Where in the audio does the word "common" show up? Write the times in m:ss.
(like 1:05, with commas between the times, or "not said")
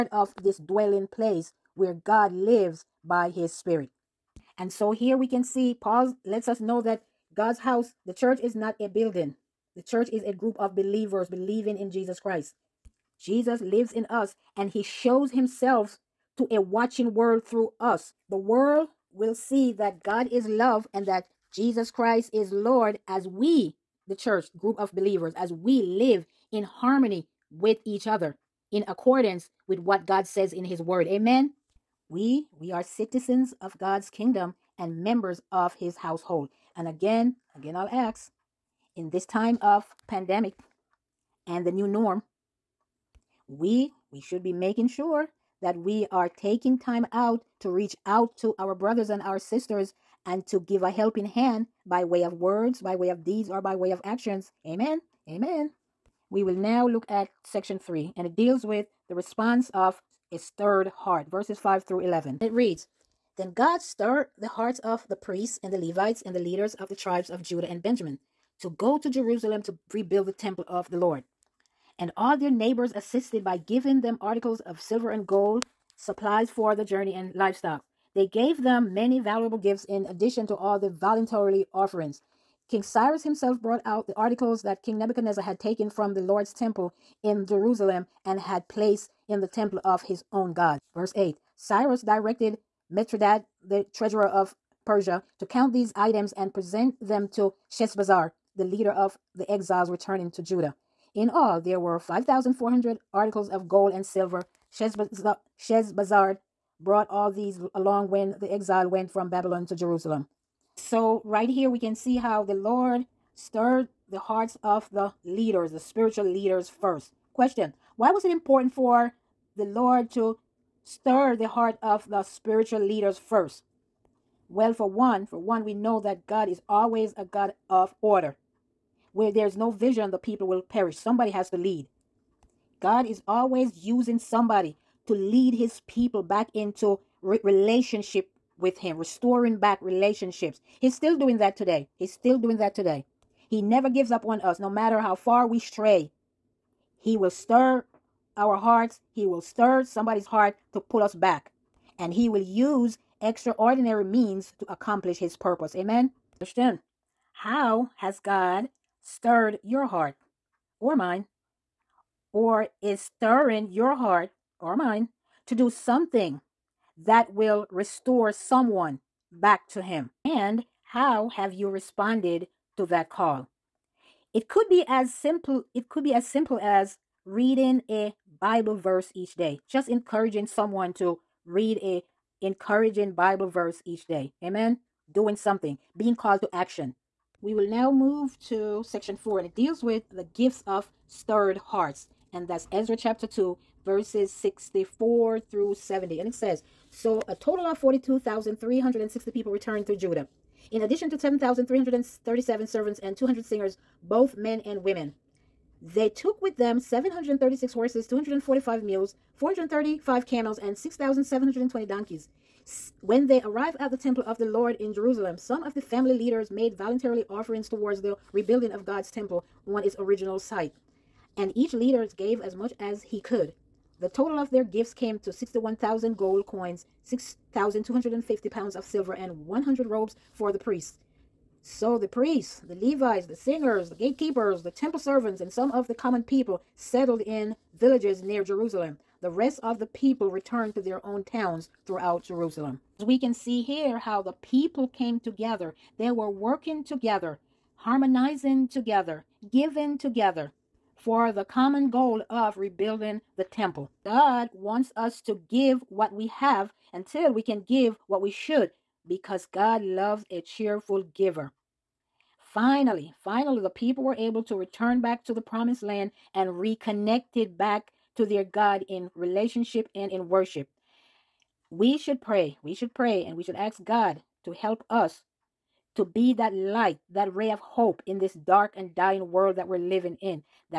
3:55, 4:11.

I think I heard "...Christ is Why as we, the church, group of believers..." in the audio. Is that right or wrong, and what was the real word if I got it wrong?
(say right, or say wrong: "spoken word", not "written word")
wrong: "Lord", not "Why".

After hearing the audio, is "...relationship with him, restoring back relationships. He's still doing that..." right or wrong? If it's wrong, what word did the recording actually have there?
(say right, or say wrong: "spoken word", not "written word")
right.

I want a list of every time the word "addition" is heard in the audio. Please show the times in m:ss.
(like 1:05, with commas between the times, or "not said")
1:20, 3:20.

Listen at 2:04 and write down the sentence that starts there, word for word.
Well, for one, for one, we know that God is always a God of order.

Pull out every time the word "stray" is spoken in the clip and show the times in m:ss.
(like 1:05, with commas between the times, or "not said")
2:25.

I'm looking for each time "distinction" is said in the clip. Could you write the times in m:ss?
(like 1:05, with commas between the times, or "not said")
not said.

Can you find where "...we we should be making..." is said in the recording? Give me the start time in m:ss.
0:43.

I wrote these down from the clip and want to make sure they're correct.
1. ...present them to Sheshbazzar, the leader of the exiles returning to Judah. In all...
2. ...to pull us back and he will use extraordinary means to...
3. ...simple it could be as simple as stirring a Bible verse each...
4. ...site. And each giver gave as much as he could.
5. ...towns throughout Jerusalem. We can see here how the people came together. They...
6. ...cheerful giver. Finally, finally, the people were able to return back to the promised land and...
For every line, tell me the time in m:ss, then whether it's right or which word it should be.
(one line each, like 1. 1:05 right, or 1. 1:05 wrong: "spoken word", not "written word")
1. 1:36 right
2. 2:30 right
3. 2:55 wrong: "reading", not "stirring"
4. 3:40 wrong: "leader", not "giver"
5. 4:01 right
6. 4:20 right.